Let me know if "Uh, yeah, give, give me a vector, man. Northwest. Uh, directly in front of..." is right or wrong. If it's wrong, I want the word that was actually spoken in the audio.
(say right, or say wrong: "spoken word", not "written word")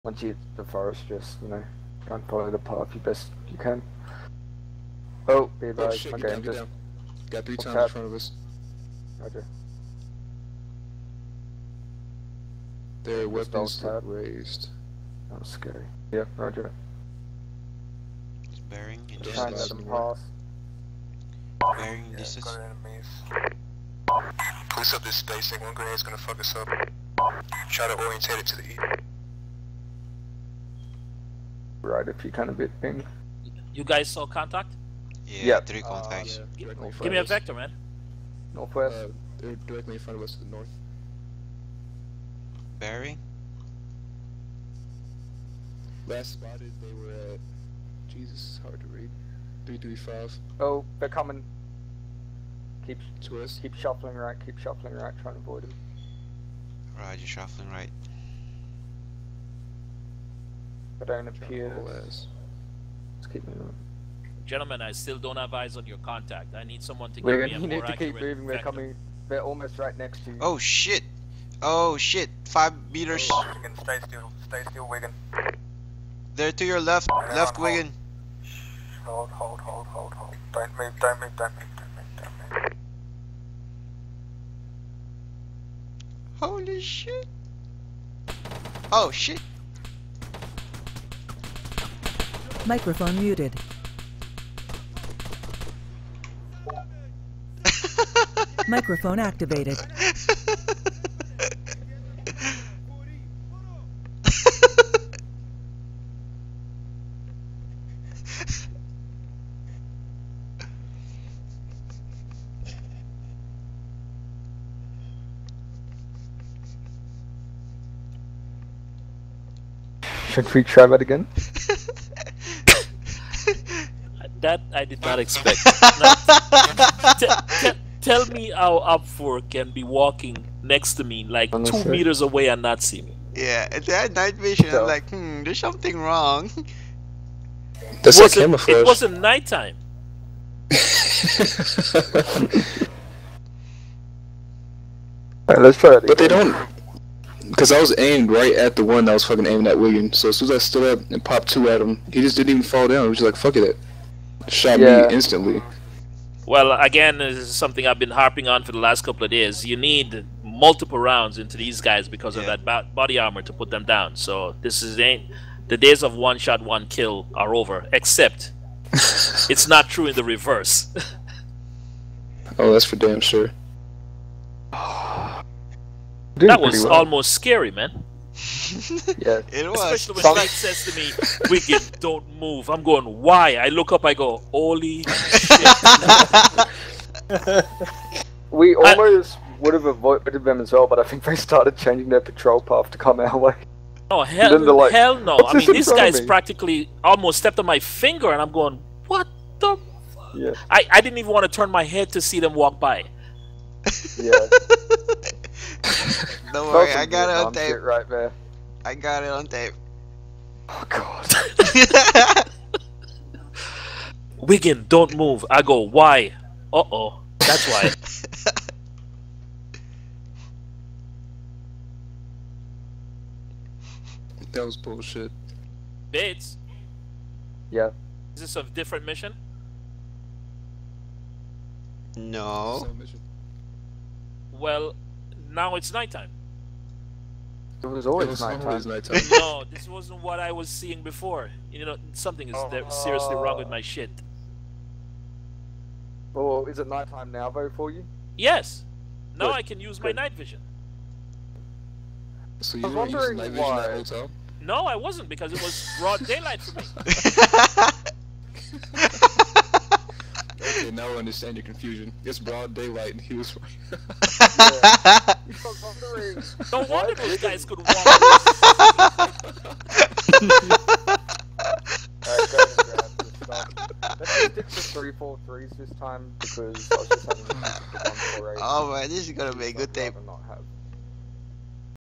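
right.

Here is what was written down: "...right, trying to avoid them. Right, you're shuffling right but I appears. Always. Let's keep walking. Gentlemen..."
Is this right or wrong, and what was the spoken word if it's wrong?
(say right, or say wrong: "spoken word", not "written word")
wrong: "moving", not "walking".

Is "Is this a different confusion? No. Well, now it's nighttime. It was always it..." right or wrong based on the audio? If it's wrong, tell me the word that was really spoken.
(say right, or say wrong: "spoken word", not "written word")
wrong: "mission", not "confusion".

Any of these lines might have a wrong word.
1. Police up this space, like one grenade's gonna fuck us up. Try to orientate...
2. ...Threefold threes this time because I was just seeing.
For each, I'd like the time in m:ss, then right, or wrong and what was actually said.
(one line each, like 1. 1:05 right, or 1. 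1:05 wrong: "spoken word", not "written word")
1. 0:24 right
2. 4:34 wrong: "having", not "seeing".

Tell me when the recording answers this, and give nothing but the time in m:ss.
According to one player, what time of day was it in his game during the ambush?
4:22.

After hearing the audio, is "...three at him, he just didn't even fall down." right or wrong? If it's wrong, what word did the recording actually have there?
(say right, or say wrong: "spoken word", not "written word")
wrong: "two", not "three".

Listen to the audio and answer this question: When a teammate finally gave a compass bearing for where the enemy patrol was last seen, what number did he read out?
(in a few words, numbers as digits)
335.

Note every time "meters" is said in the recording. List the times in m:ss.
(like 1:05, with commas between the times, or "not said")
1:12, 2:11.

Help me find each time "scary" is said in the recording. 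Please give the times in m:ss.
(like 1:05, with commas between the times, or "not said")
0:15, 2:57.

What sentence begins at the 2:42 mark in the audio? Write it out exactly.
of that body armor to put them down.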